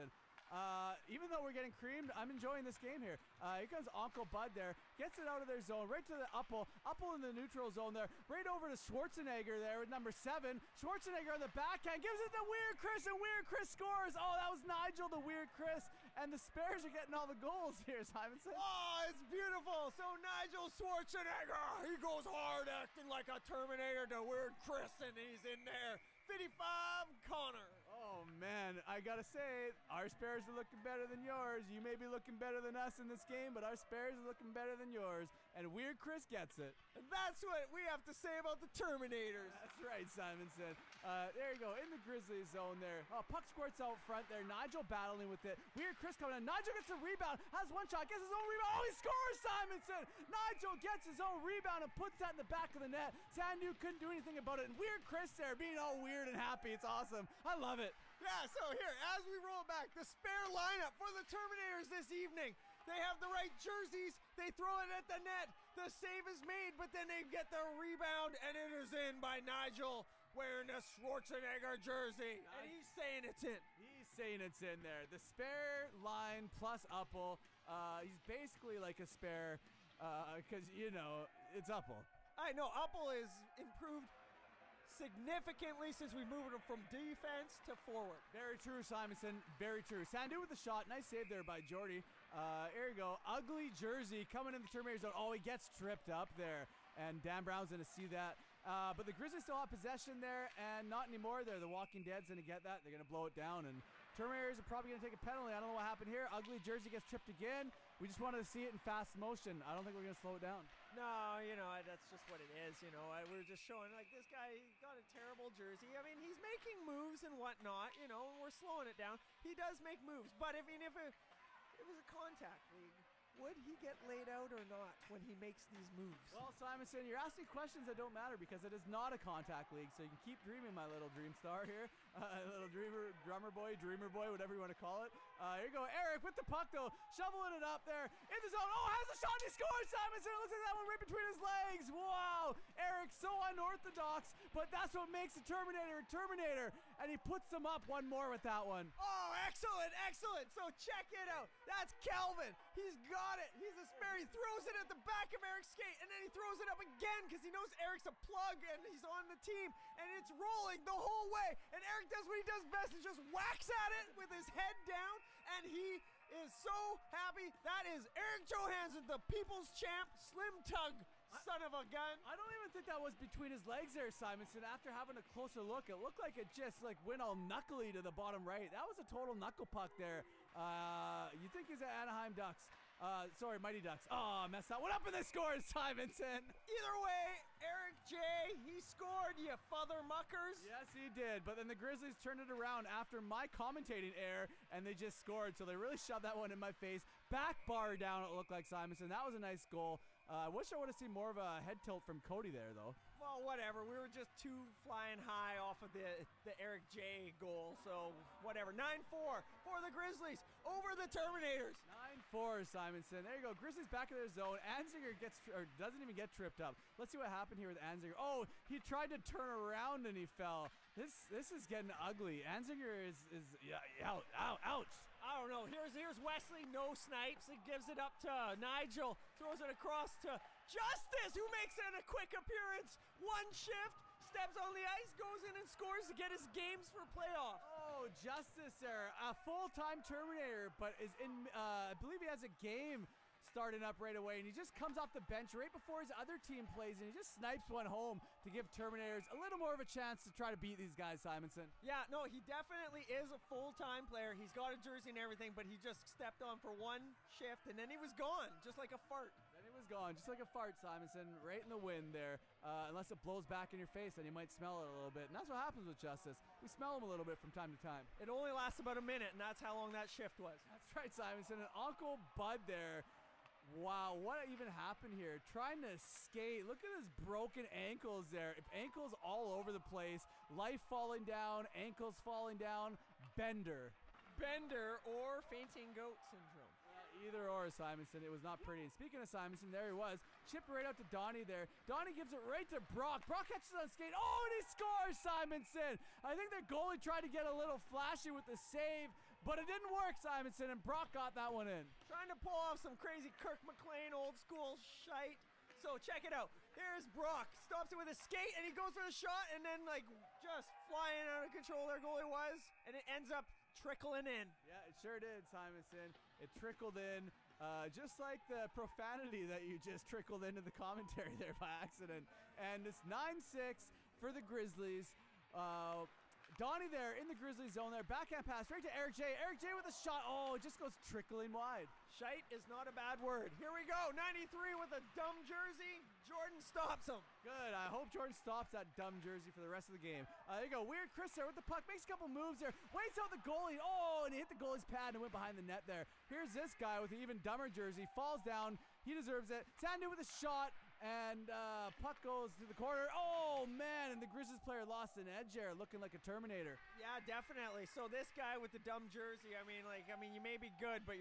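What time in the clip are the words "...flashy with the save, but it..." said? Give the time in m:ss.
4:57.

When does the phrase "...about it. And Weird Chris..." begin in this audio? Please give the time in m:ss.
0:54.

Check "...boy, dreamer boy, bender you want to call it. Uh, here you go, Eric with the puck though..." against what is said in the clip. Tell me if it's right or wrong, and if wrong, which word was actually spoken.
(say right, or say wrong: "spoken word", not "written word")
wrong: "whatever", not "bender".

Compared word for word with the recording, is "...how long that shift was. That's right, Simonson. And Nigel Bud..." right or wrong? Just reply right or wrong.
wrong.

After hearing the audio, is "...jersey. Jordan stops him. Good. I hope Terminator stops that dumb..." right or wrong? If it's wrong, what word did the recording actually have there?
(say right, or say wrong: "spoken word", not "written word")
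wrong: "Jordan", not "Terminator".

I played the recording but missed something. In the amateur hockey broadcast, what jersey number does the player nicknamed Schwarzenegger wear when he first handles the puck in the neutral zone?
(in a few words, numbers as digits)
7.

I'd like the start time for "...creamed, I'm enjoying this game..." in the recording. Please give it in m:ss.
0:01.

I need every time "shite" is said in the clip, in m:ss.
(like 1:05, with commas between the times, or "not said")
5:04, 5:32.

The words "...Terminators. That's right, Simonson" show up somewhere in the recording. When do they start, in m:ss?
0:38.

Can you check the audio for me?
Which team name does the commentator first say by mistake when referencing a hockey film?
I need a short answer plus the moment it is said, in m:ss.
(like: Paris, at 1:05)
Anaheim Ducks, at 3:02.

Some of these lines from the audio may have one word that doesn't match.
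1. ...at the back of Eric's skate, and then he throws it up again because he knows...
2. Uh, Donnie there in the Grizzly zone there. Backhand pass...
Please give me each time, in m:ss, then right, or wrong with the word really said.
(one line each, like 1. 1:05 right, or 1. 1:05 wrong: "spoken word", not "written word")
1. 2:34 right
2. 5:25 right.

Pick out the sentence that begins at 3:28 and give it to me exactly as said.
9-4 for the Grizzlies over the Terminators.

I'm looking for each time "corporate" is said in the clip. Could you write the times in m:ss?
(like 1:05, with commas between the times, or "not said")
not said.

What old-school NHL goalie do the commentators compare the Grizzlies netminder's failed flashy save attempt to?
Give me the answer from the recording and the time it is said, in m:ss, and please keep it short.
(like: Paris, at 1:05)
Kirk McLean, at 5:03.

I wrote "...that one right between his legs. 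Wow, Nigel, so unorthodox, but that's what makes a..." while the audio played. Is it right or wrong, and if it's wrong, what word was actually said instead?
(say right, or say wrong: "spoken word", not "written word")
wrong: "Eric", not "Nigel".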